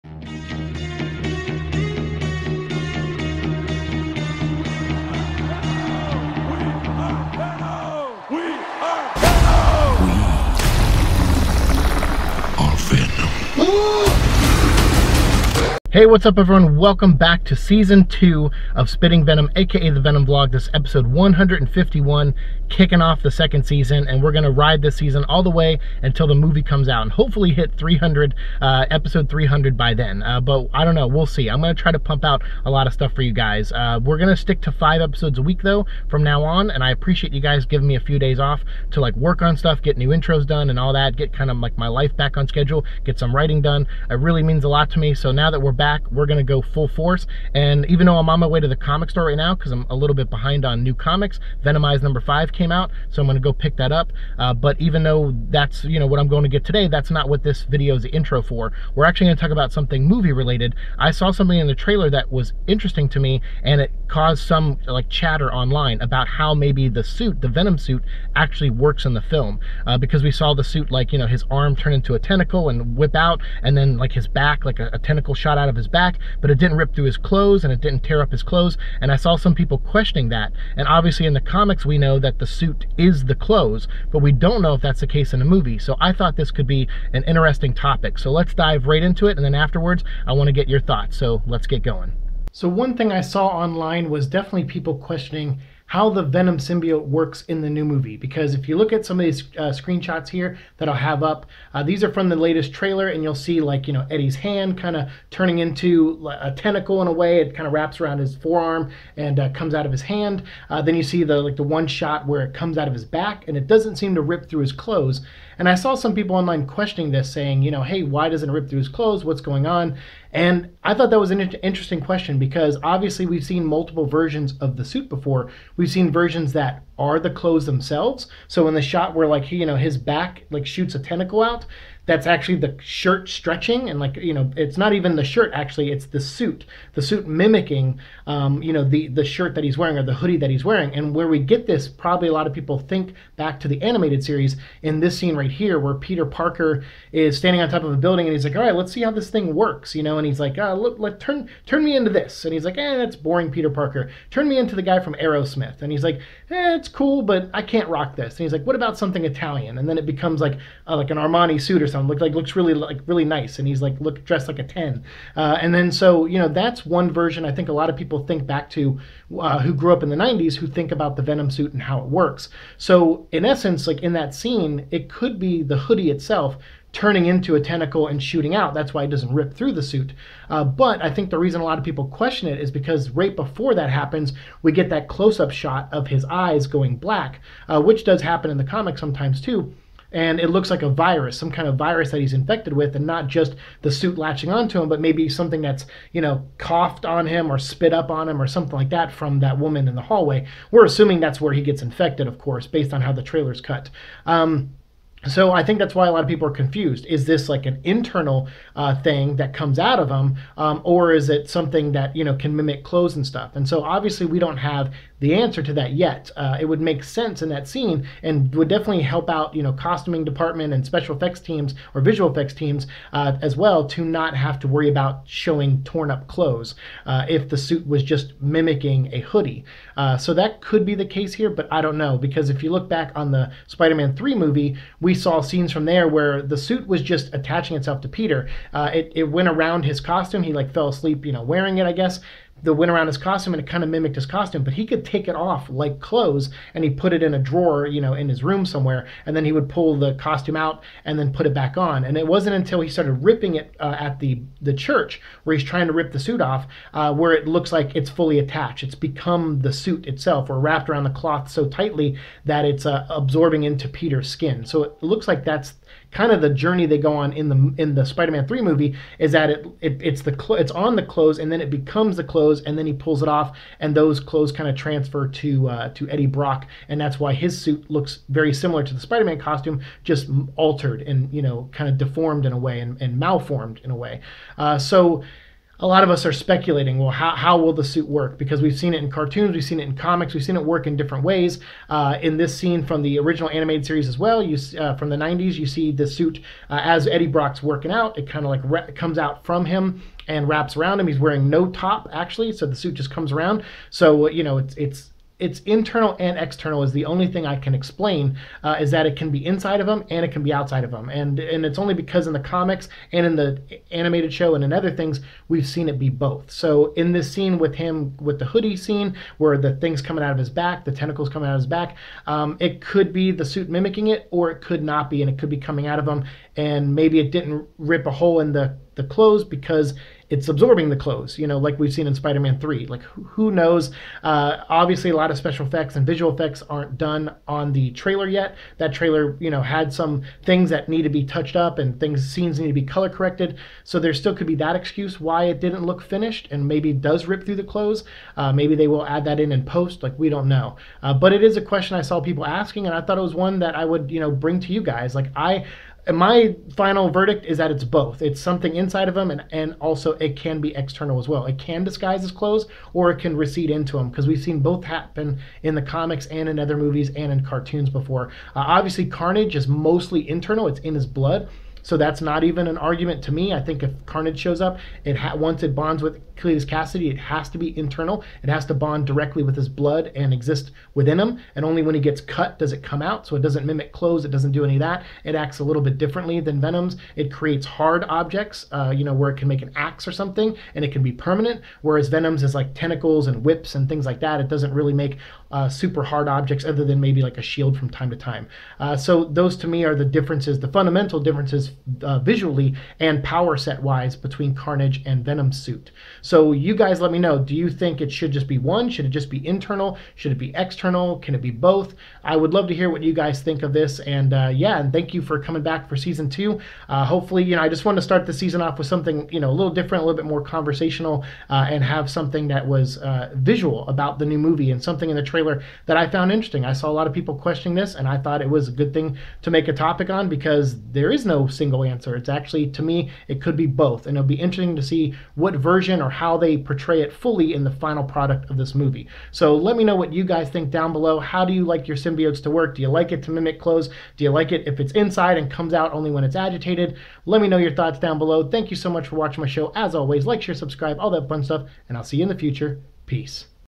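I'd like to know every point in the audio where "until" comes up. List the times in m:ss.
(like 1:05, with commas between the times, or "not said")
0:26, 4:12.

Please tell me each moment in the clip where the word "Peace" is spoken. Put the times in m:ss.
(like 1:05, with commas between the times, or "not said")
7:33.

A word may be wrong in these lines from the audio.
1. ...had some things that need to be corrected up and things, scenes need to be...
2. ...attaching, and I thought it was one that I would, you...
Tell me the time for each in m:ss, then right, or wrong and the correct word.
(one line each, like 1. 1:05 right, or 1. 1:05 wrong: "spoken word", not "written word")
1. 5:39 wrong: "touched", not "corrected"
2. 5:52 wrong: "asking", not "attaching".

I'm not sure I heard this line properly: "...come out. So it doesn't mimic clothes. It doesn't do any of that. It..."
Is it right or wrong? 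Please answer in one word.
right.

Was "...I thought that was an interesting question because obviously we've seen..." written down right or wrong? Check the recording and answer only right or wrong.
right.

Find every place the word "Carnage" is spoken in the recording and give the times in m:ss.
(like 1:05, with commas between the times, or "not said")
6:09, 6:14, 6:44.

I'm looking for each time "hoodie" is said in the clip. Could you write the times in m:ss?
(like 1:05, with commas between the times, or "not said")
2:20, 2:55, 3:49, 5:18.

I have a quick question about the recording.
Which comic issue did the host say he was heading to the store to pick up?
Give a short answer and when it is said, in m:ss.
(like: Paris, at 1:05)
Venomized #5, at 0:51.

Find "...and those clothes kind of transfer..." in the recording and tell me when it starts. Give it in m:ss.
4:33.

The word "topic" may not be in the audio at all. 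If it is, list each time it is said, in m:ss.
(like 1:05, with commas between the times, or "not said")
1:27, 7:09.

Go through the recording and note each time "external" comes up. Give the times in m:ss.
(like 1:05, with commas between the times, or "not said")
5:06, 6:00, 6:50.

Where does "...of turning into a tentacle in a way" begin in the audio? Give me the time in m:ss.
1:44.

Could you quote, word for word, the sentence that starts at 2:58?
That's why it doesn't rip through the suit.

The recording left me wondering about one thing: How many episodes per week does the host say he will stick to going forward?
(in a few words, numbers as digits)
5.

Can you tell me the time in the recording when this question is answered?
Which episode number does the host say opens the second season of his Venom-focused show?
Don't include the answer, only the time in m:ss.
0:21.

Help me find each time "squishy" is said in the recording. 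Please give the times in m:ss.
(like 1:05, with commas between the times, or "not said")
not said.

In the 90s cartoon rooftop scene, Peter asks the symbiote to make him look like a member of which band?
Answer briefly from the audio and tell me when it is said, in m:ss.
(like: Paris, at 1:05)
Aerosmith, at 2:35.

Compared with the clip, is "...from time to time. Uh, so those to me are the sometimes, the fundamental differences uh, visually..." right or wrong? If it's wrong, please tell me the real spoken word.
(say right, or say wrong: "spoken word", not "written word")
wrong: "differences", not "sometimes".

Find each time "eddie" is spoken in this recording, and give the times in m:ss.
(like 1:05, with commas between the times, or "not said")
1:44, 4:36, 4:57.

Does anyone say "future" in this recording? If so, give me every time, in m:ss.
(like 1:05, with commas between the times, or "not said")
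7:32.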